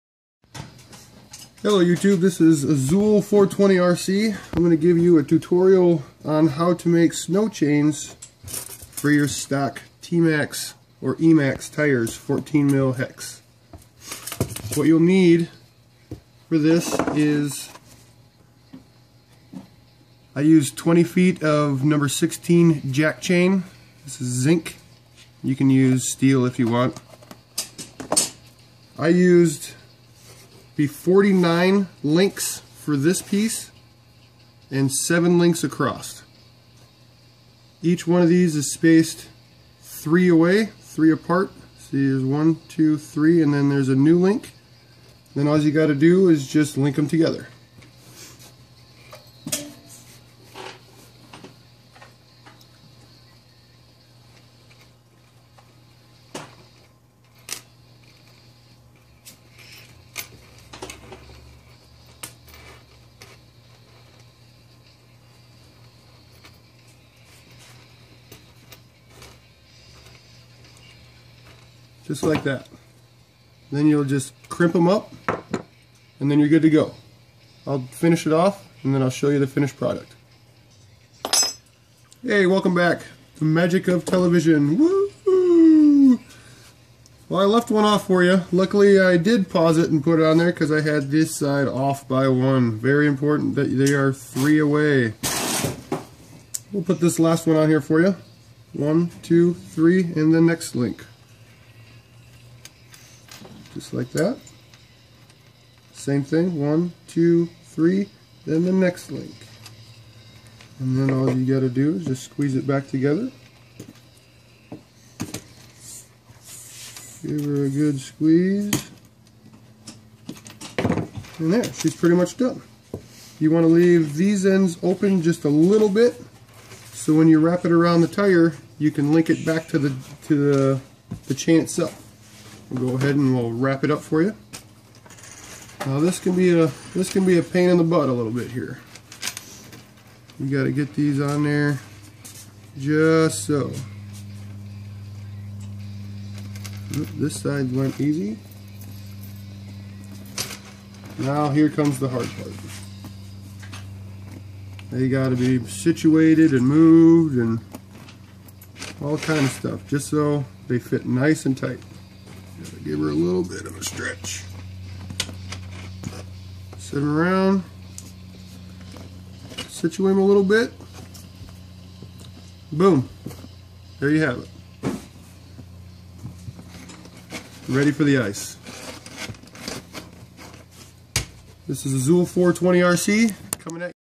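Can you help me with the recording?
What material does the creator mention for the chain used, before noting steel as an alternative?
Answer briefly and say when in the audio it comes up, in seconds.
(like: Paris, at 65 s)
Zinc, at 24 s.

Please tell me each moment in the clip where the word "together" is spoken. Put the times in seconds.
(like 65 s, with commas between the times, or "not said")
47 s, 112 s.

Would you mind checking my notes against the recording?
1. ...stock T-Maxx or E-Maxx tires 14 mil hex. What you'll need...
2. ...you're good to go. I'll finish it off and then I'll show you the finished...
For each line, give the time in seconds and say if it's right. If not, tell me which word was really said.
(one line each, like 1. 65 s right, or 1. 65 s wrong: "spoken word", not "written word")
1. 9 s right
2. 76 s right.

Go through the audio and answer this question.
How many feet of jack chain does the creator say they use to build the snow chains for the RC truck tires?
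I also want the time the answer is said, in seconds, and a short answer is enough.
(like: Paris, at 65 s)
20 feet, at 20 s.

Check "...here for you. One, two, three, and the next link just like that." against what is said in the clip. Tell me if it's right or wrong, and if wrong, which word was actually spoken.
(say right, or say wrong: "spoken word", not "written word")
right.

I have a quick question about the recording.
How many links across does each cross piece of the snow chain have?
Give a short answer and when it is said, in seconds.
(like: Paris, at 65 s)
7, at 34 s.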